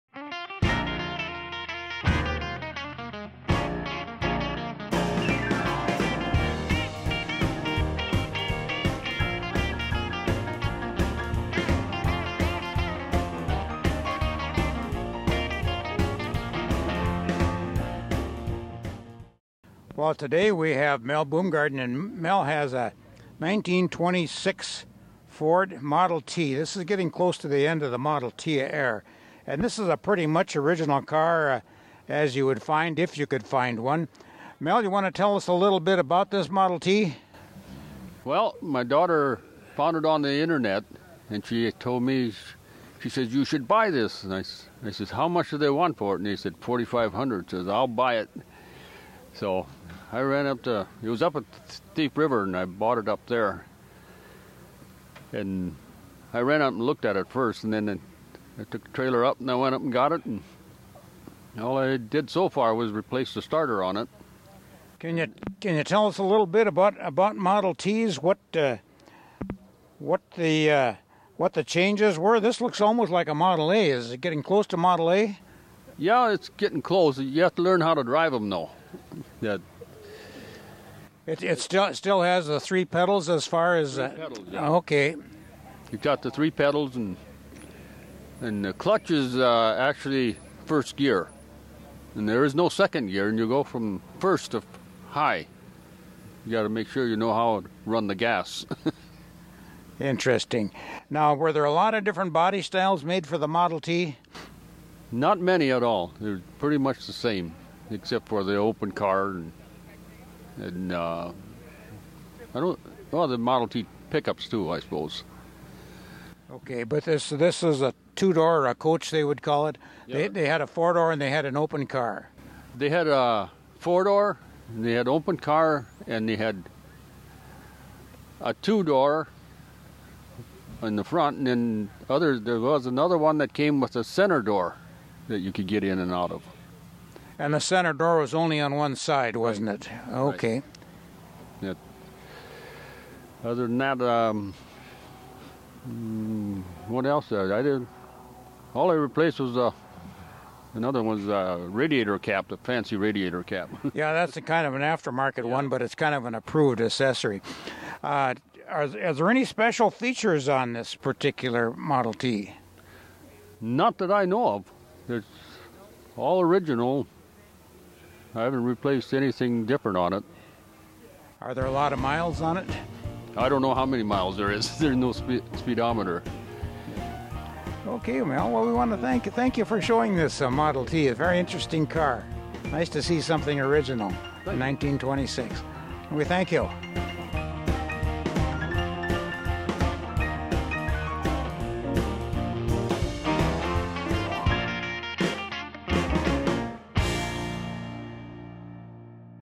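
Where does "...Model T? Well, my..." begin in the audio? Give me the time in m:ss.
0:36.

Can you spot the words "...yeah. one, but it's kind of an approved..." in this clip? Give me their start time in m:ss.
2:35.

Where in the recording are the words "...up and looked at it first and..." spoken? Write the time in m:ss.
0:56.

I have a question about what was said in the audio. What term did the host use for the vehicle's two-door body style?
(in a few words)
coach.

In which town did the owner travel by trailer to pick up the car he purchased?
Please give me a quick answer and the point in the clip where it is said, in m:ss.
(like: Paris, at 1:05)
Thief River, at 0:51.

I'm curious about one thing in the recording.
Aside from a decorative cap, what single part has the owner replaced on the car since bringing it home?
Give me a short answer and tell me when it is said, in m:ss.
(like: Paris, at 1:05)
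starter, at 1:03.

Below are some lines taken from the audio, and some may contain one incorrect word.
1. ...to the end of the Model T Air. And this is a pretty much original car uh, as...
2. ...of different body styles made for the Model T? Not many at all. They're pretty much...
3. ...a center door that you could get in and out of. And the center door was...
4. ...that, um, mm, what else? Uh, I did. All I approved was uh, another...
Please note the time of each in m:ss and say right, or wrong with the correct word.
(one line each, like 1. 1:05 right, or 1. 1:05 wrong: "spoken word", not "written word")
1. 0:27 right
2. 1:41 right
3. 2:13 right
4. 2:23 wrong: "replaced", not "approved".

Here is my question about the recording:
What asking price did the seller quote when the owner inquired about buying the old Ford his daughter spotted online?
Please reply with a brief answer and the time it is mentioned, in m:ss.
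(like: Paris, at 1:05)
4500, at 0:46.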